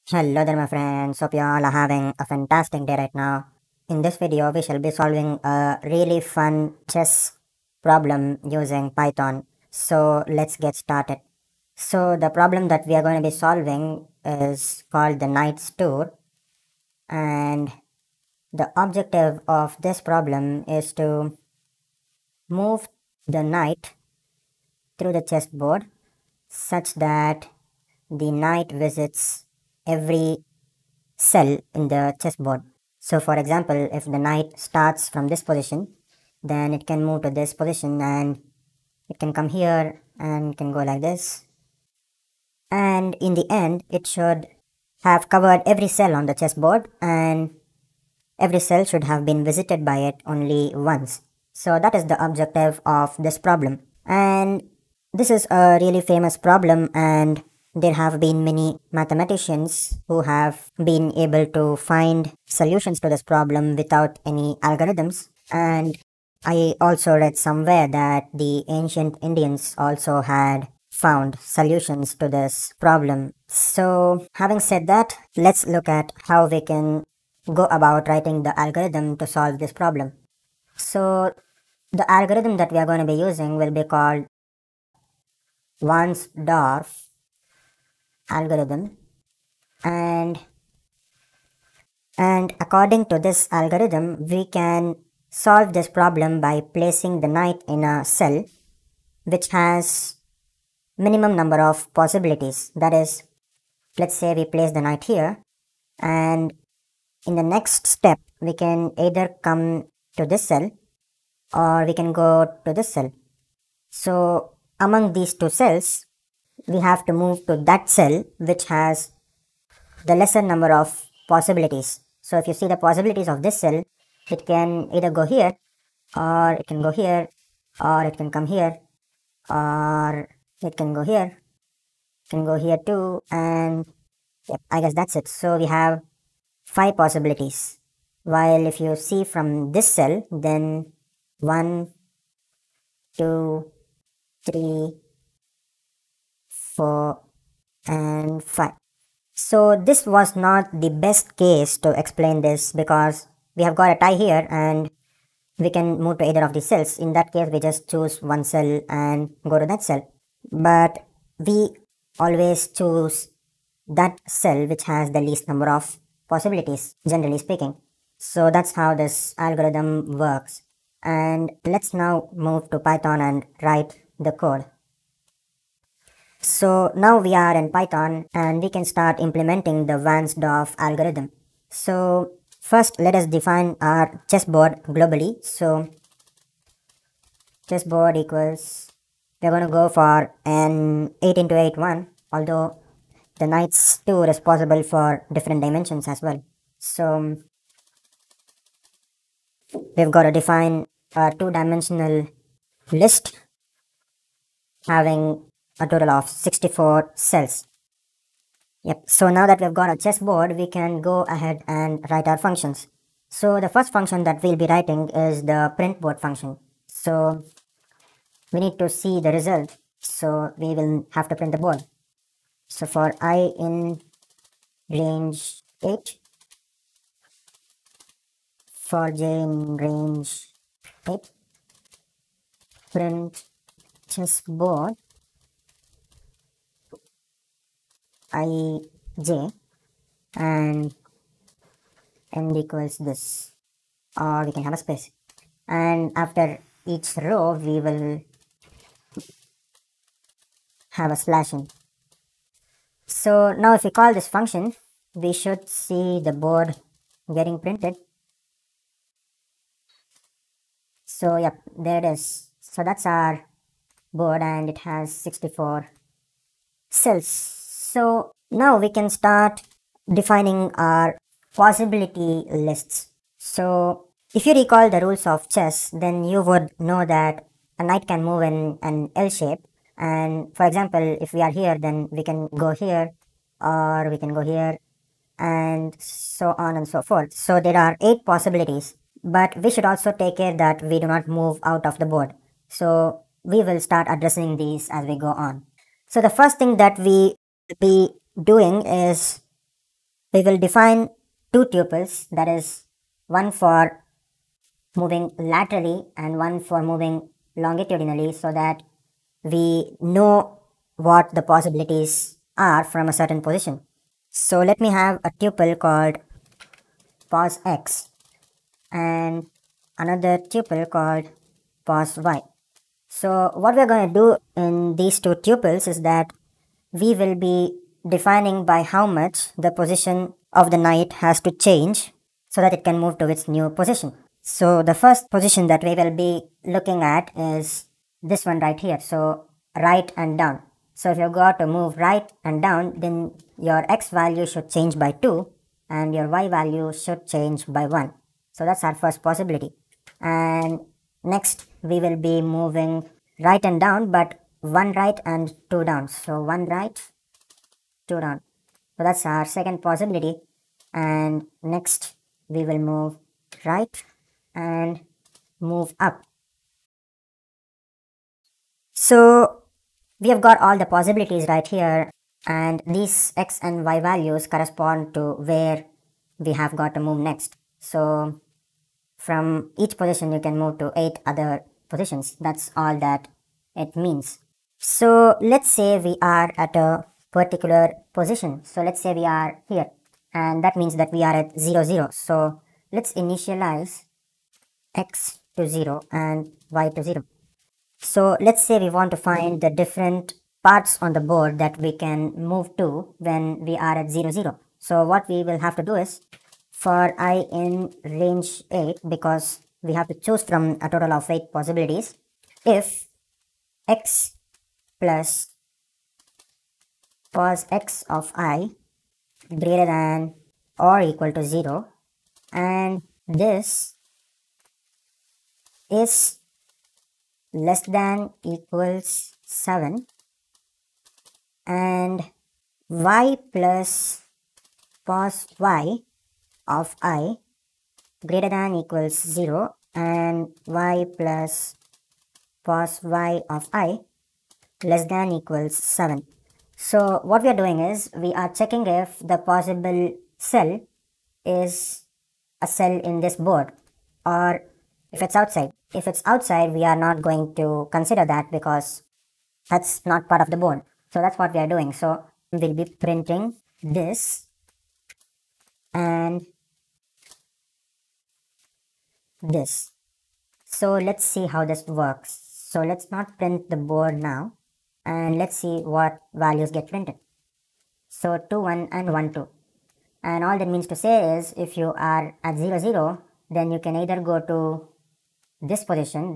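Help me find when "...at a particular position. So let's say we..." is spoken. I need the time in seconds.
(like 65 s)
386 s.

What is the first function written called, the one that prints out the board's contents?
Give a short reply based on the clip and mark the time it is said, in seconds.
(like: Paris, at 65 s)
printboard, at 215 s.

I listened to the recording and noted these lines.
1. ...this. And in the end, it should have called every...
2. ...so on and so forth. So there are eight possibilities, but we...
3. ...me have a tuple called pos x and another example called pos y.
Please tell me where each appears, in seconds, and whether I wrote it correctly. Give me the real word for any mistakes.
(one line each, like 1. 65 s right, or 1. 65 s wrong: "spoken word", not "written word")
1. 41 s wrong: "covered", not "called"
2. 286 s right
3. 314 s wrong: "tuple", not "example".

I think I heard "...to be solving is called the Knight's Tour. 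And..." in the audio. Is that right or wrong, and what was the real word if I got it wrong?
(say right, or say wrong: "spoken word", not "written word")
right.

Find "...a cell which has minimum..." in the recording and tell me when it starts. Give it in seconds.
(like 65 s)
97 s.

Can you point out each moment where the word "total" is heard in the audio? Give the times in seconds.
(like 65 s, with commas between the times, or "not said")
205 s, 410 s.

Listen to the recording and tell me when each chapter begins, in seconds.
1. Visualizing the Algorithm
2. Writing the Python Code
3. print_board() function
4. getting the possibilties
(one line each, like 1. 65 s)
1. 9 s
2. 174 s
3. 213 s
4. 295 s.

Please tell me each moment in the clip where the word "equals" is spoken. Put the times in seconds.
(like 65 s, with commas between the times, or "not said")
188 s, 242 s, 421 s, 428 s, 438 s, 445 s.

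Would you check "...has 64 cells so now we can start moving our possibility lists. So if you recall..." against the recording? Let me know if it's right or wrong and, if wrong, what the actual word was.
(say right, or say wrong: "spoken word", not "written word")
wrong: "defining", not "moving".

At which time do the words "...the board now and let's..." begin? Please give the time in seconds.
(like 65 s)
473 s.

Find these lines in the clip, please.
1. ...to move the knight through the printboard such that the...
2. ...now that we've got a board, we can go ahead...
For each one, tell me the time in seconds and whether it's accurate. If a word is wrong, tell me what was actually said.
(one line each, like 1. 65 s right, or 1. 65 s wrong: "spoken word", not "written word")
1. 20 s wrong: "chessboard", not "printboard"
2. 209 s wrong: "chessboard", not "board".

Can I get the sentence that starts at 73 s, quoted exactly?
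So having said that, let's look at how we can go about writing the algorithm to solve this problem.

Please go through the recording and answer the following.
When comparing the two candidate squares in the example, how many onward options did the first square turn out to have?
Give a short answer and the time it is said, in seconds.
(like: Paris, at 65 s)
5, at 136 s.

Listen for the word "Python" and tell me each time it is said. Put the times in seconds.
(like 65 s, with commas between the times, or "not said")
8 s, 172 s, 177 s.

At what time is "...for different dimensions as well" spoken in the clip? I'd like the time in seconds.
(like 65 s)
194 s.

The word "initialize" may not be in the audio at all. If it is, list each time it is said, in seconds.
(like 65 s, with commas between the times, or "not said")
393 s.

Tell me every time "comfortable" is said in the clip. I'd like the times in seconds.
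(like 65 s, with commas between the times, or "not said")
not said.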